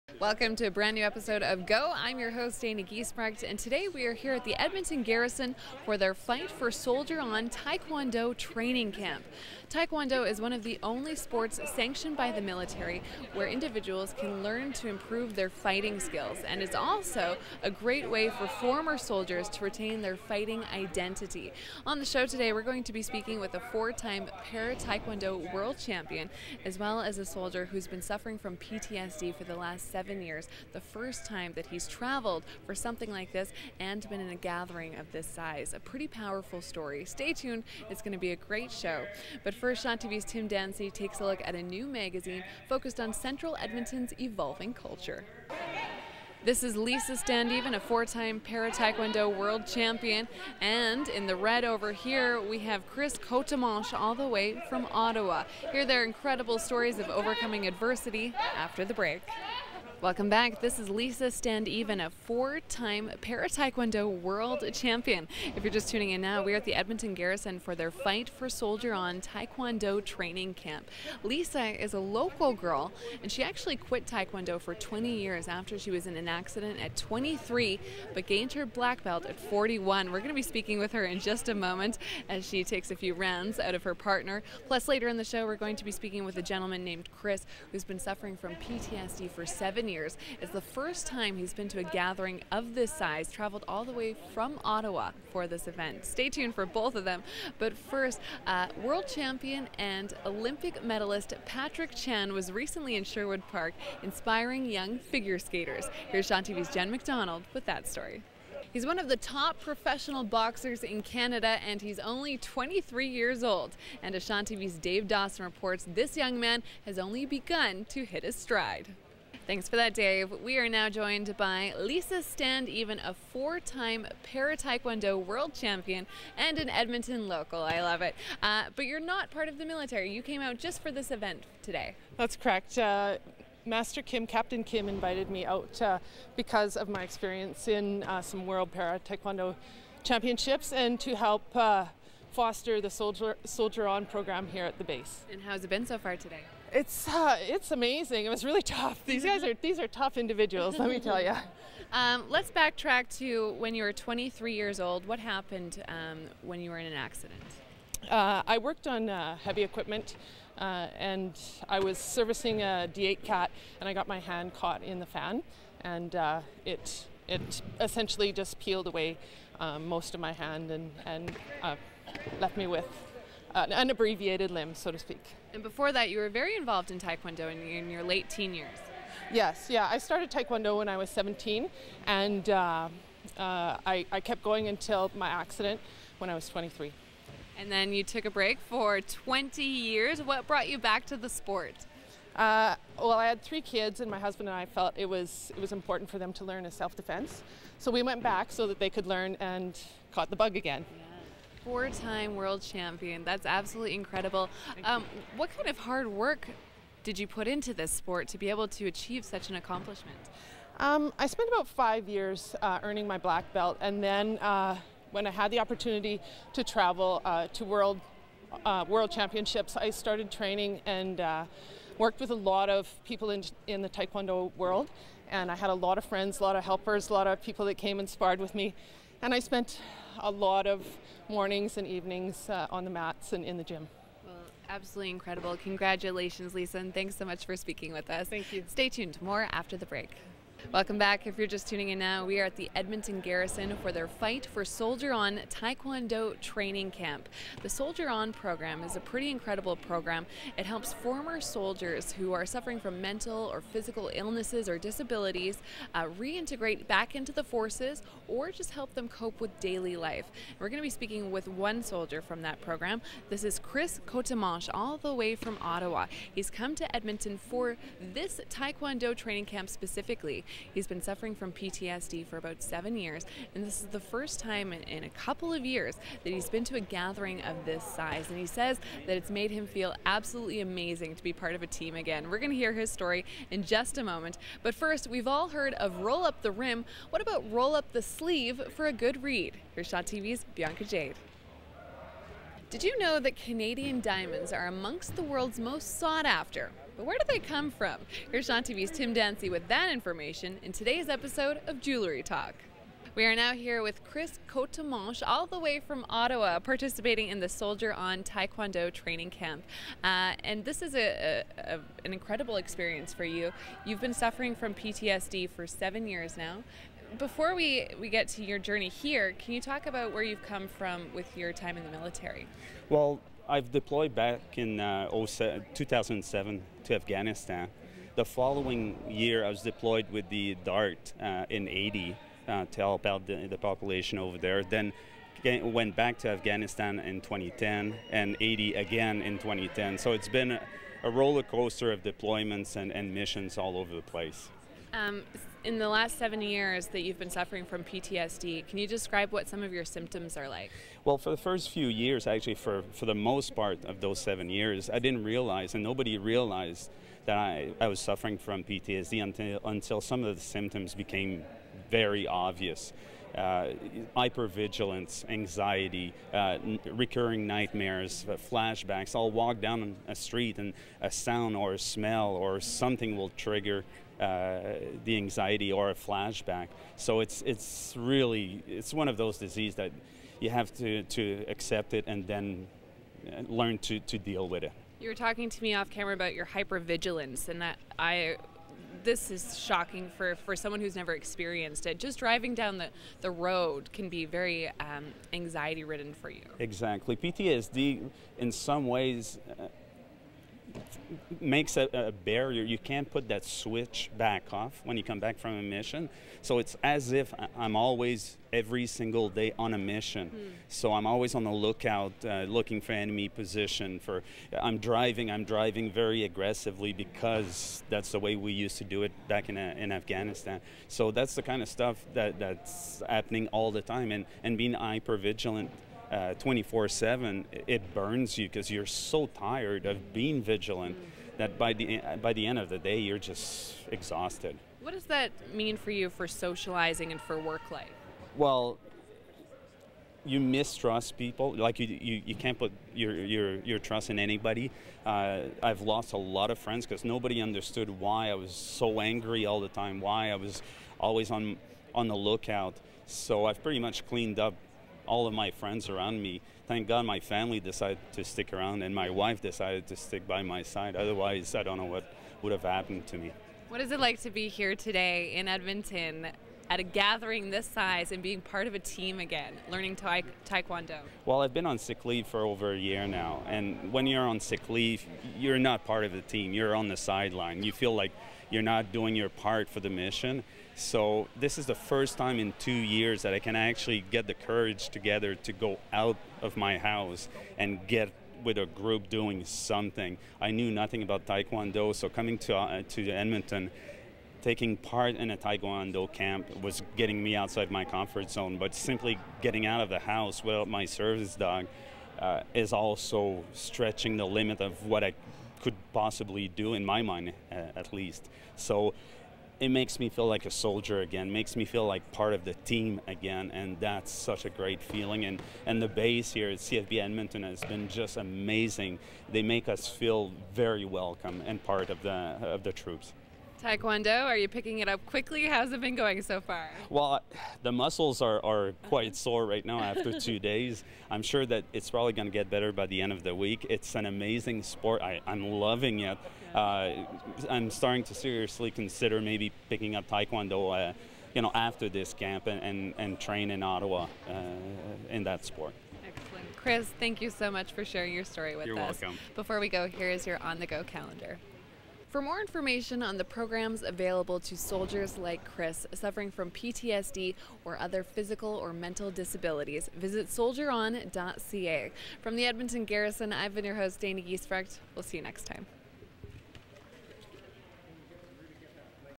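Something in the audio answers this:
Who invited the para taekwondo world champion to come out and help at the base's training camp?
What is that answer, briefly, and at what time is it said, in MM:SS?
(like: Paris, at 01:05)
Captain Kim, at 02:14.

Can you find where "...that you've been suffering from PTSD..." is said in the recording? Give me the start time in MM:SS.
05:46.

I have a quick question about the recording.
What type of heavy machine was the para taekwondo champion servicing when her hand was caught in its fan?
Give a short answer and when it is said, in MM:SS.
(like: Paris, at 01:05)
D8 Cat, at 02:42.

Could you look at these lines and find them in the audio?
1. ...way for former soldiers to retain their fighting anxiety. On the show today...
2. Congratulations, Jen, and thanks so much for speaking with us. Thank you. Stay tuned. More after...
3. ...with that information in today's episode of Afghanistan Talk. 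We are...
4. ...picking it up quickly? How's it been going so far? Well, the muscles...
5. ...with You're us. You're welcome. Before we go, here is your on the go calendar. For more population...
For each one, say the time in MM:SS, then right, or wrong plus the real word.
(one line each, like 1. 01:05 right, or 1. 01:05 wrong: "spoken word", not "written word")
1. 00:18 wrong: "identity", not "anxiety"
2. 03:55 wrong: "Lisa", not "Jen"
3. 04:59 wrong: "Jewelry", not "Afghanistan"
4. 08:44 right
5. 09:08 wrong: "information", not "population".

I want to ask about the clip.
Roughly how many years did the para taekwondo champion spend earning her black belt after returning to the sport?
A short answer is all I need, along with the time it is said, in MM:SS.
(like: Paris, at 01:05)
5, at 03:31.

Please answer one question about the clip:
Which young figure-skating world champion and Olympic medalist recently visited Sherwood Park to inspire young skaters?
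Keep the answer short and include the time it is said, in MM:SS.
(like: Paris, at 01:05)
Patrick Chan, at 01:41.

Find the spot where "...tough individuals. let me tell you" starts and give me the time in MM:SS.
02:29.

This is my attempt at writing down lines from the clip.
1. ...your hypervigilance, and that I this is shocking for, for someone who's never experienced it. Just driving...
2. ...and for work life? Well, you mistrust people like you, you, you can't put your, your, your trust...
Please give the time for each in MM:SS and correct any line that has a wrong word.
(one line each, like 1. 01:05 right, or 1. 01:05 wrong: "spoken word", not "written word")
1. 06:26 right
2. 07:17 right.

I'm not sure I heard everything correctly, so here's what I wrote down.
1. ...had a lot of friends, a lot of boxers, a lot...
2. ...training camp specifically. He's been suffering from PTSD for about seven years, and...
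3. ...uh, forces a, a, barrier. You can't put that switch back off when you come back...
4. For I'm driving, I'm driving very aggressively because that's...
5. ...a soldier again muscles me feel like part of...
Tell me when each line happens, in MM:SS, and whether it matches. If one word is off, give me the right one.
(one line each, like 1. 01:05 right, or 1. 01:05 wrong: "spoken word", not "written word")
1. 03:45 wrong: "helpers", not "boxers"
2. 04:29 right
3. 06:39 wrong: "makes", not "forces"
4. 06:53 right
5. 08:30 wrong: "makes", not "muscles".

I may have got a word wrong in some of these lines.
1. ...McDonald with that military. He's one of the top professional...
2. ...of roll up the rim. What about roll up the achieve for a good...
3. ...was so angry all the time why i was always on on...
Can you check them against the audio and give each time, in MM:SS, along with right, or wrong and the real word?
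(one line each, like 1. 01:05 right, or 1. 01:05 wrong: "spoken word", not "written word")
1. 01:46 wrong: "story", not "military"
2. 04:45 wrong: "sleeve", not "achieve"
3. 07:28 right.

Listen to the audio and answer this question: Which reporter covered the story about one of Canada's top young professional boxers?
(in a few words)
Dave Dawson.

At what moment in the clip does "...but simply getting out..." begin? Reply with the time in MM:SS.
08:18.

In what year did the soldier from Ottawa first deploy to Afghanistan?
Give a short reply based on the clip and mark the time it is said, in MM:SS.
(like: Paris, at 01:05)
2007, at 05:25.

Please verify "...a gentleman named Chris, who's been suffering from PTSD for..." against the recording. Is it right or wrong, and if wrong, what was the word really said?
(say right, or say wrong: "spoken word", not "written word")
right.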